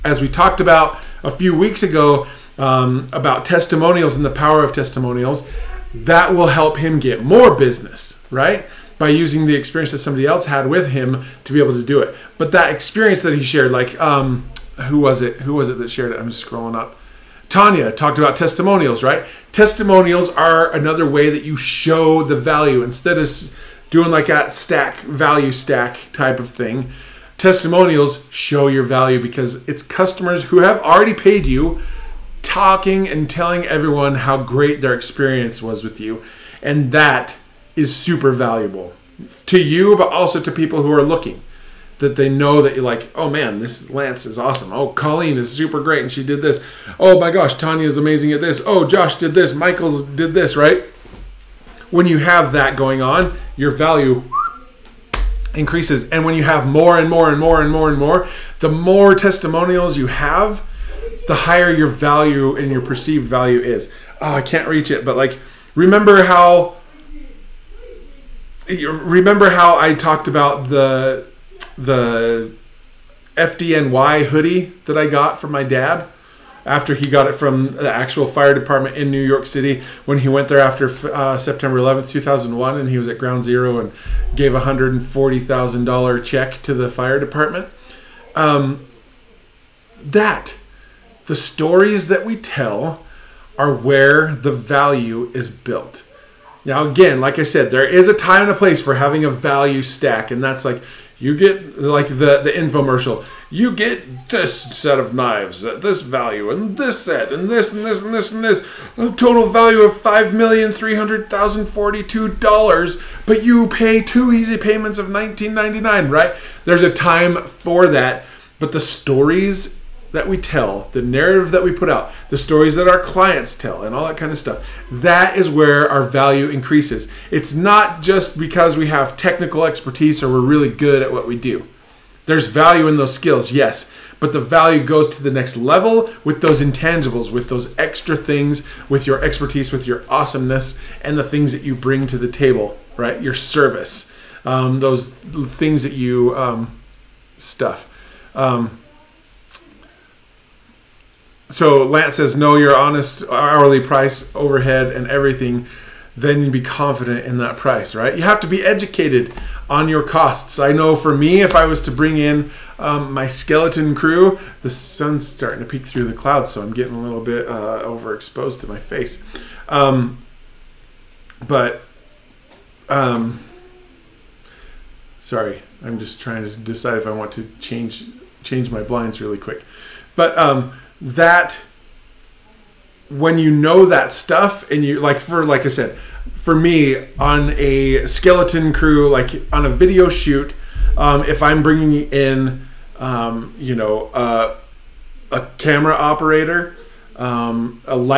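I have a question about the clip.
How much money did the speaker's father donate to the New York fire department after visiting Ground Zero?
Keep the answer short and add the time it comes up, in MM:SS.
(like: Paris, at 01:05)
$140,000, at 01:24.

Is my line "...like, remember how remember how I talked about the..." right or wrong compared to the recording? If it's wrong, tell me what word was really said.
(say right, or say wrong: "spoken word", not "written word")
right.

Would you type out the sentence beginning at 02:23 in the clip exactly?
Your service, um, those things that you um, stuff.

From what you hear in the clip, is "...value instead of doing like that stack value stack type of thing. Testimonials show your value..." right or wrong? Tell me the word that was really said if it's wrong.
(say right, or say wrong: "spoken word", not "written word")
right.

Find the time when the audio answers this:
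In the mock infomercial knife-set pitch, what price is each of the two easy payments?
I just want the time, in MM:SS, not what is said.
01:55.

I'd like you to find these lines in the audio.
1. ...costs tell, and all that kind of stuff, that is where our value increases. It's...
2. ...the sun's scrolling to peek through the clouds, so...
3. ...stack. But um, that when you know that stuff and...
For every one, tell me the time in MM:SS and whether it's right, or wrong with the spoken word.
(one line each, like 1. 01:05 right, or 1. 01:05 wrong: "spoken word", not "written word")
1. 02:02 wrong: "clients", not "costs"
2. 02:44 wrong: "starting", not "scrolling"
3. 02:59 wrong: "quick", not "stack".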